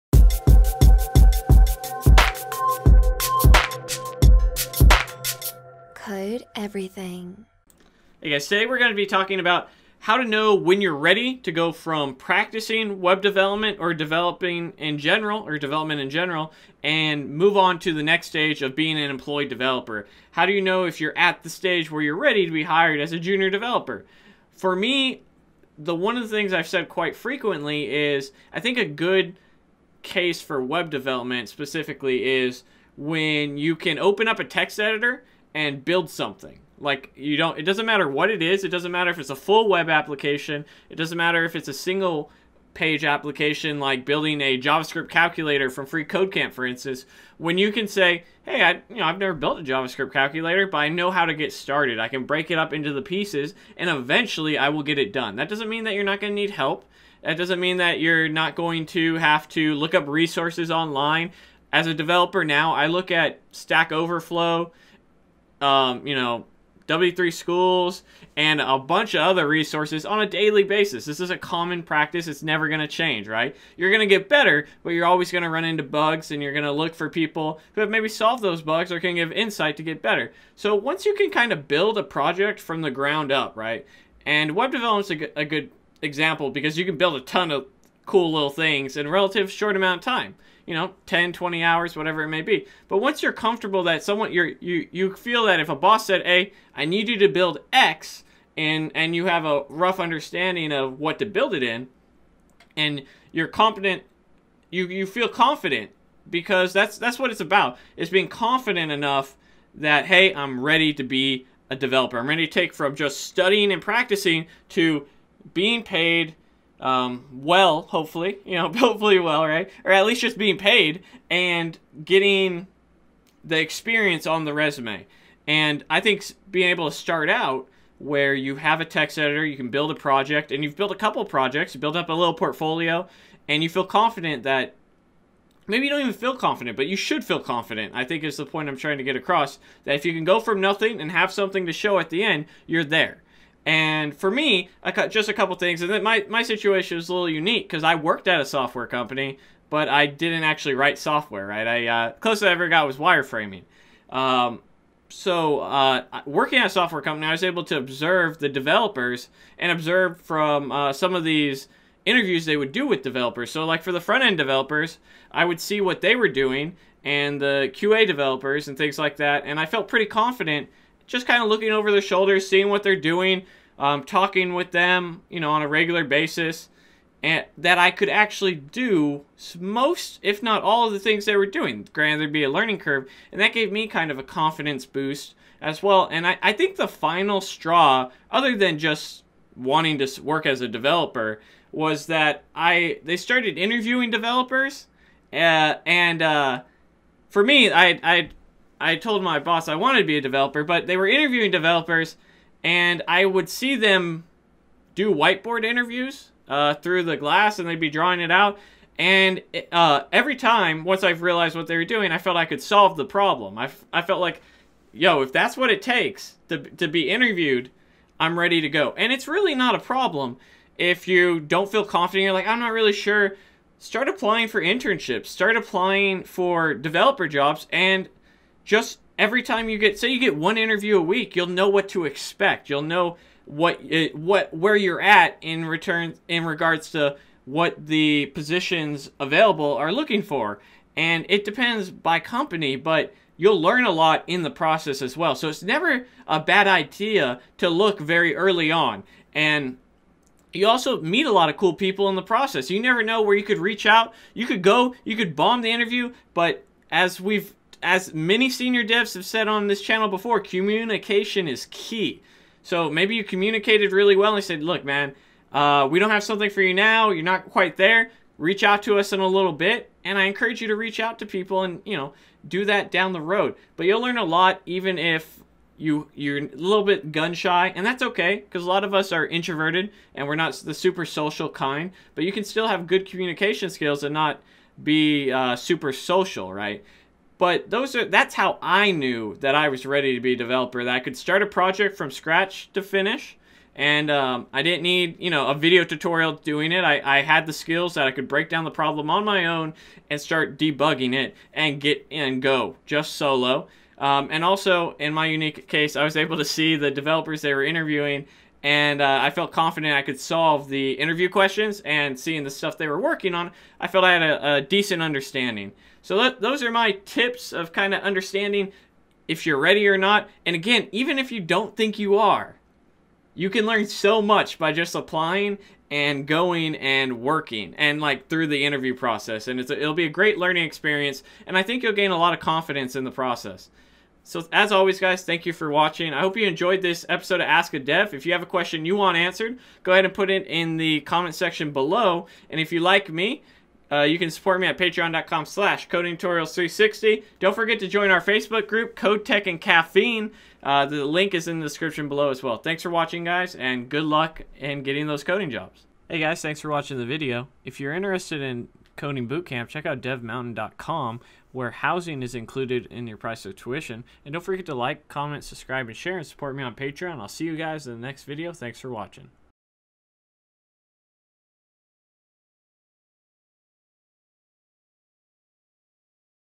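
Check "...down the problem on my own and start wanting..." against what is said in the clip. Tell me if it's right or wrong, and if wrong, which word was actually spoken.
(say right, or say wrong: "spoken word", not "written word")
wrong: "debugging", not "wanting".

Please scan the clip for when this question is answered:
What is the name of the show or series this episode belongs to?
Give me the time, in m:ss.
5:37.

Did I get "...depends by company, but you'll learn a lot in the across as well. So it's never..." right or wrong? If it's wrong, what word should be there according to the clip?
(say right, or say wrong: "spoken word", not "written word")
wrong: "process", not "across".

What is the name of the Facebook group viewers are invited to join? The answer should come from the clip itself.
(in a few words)
Code Tech and Caffeine.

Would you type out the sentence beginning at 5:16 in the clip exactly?
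So that, those are my tips of kind of understanding if you're ready or not.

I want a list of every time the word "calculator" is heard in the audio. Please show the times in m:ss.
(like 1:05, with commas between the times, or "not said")
0:45, 0:50.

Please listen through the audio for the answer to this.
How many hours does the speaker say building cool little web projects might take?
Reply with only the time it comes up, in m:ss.
1:31.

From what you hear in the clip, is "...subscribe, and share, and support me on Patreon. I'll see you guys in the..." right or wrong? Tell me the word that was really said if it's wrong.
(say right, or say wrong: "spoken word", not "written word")
right.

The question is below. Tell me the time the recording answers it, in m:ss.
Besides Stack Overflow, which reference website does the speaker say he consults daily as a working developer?
1:06.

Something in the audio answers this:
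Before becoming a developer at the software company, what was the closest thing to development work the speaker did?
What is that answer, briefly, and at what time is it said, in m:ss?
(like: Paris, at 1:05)
Wireframing, at 2:32.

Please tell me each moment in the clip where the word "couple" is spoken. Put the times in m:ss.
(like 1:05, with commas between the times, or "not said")
2:10, 2:25.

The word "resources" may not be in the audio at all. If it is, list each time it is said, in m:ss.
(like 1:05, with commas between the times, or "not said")
1:00, 1:09.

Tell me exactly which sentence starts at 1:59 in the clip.
Or at least just being paid and getting the experience on the resume.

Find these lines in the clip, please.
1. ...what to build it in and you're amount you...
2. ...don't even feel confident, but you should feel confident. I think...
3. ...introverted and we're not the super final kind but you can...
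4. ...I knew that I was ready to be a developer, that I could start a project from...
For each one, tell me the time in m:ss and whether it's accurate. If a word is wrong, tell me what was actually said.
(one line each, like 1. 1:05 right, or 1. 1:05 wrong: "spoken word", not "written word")
1. 1:40 wrong: "competent", not "amount"
2. 2:15 right
3. 4:39 wrong: "social", not "final"
4. 4:48 right.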